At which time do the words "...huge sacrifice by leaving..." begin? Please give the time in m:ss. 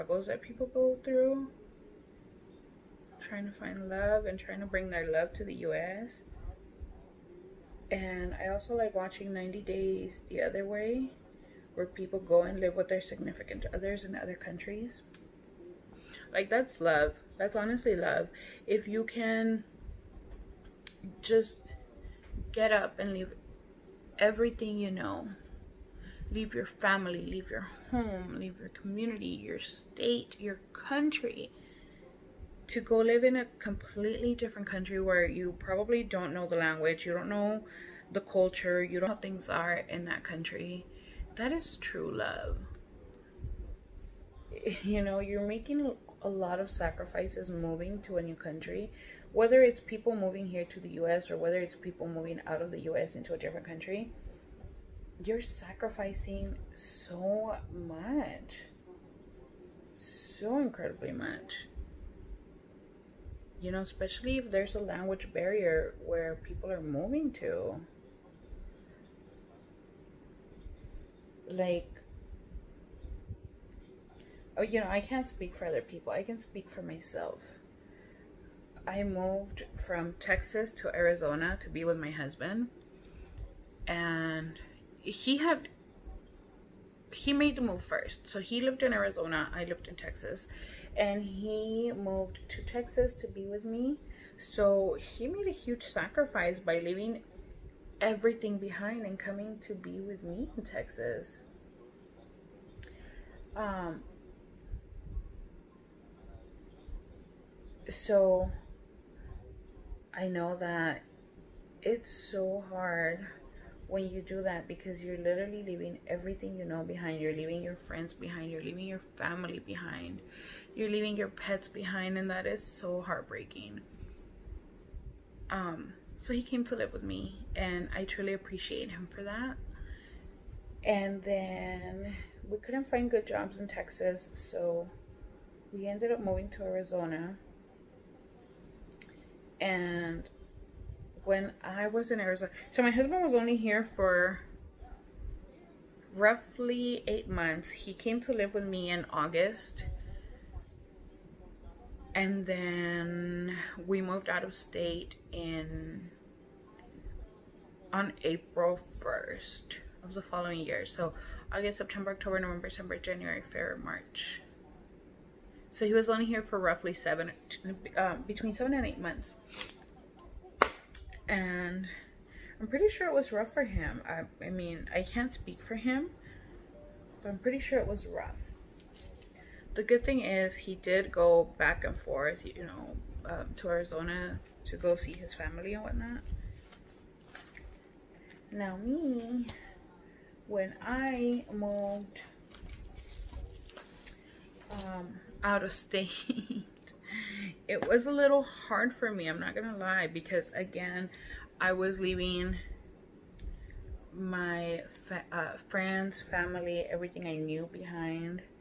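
1:35.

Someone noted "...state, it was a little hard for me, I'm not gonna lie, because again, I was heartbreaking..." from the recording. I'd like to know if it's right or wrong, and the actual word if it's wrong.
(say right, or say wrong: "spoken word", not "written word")
wrong: "leaving", not "heartbreaking".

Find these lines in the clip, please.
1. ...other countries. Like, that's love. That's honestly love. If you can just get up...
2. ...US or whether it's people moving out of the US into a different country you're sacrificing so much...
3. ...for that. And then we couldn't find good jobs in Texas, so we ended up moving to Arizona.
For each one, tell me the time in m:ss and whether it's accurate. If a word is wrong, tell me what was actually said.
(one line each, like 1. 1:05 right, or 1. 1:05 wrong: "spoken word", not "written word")
1. 0:14 right
2. 0:51 right
3. 2:09 right.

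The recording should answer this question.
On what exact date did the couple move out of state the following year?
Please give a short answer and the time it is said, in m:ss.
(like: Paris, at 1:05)
April 1st, at 2:38.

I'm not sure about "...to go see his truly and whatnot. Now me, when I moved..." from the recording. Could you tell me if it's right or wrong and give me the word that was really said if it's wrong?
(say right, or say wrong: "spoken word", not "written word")
wrong: "family", not "truly".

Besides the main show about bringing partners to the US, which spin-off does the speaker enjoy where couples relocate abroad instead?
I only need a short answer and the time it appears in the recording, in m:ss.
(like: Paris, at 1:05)
90 Days the Other Way, at 0:09.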